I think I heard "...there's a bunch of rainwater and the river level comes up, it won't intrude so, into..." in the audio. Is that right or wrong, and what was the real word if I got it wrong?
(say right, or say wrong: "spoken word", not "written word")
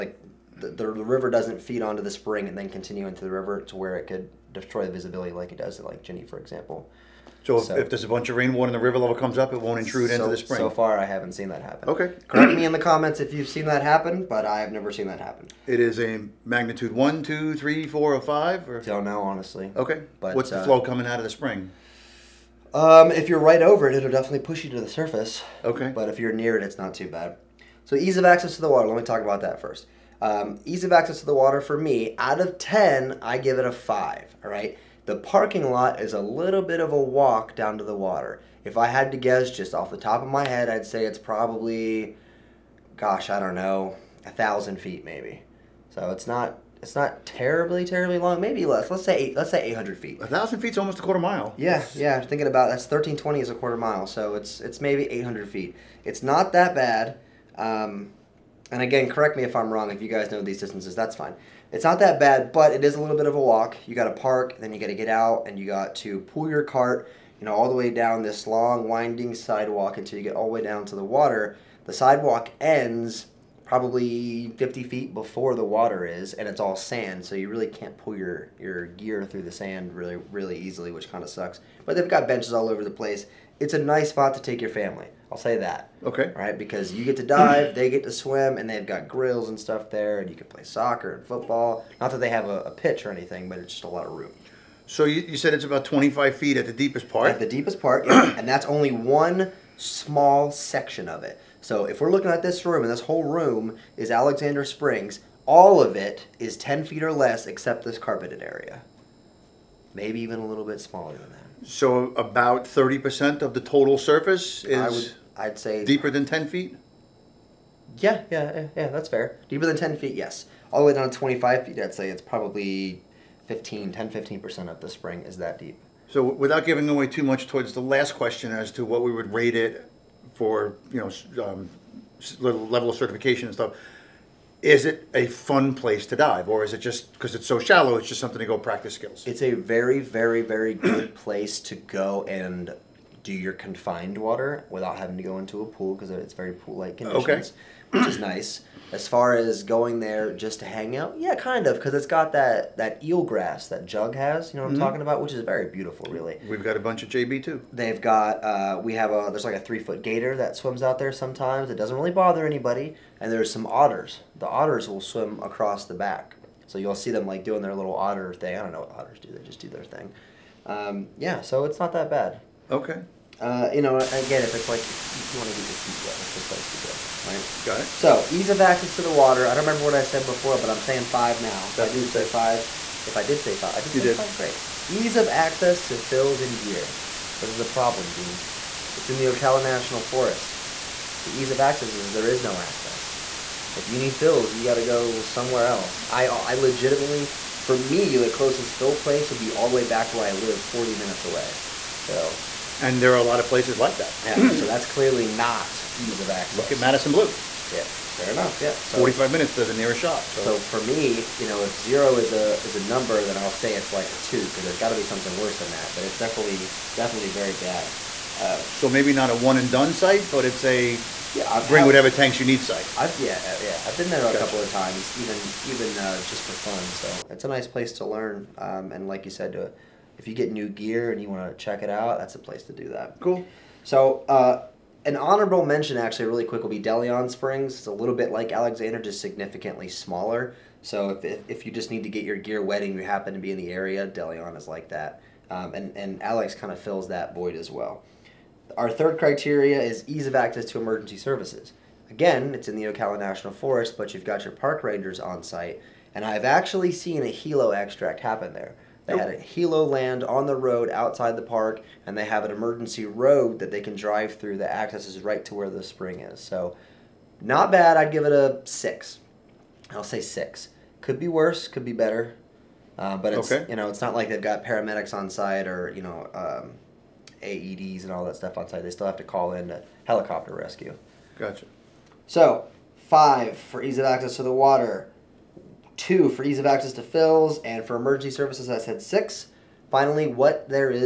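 right.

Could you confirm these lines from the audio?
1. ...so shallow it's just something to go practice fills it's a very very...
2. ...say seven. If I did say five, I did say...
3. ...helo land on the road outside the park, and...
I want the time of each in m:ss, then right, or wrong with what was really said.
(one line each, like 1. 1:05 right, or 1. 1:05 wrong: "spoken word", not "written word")
1. 2:17 wrong: "skills", not "fills"
2. 3:02 wrong: "five", not "seven"
3. 4:19 right.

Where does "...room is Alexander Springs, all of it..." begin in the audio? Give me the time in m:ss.
1:43.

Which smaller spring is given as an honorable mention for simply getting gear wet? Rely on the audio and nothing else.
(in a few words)
DeLeon Springs.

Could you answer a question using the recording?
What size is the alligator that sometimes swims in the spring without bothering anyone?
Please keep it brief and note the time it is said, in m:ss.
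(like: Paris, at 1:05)
3 feet, at 2:39.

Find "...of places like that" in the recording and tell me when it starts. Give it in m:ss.
3:23.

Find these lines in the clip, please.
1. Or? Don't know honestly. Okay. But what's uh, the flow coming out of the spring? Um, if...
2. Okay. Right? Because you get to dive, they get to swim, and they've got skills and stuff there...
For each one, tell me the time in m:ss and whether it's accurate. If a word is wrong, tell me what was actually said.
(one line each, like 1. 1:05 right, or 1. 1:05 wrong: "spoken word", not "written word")
1. 0:18 right
2. 1:26 wrong: "grills", not "skills".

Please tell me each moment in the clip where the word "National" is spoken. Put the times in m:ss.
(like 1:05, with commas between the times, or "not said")
3:09, 4:13.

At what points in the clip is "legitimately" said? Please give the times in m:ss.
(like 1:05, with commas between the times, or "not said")
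3:16.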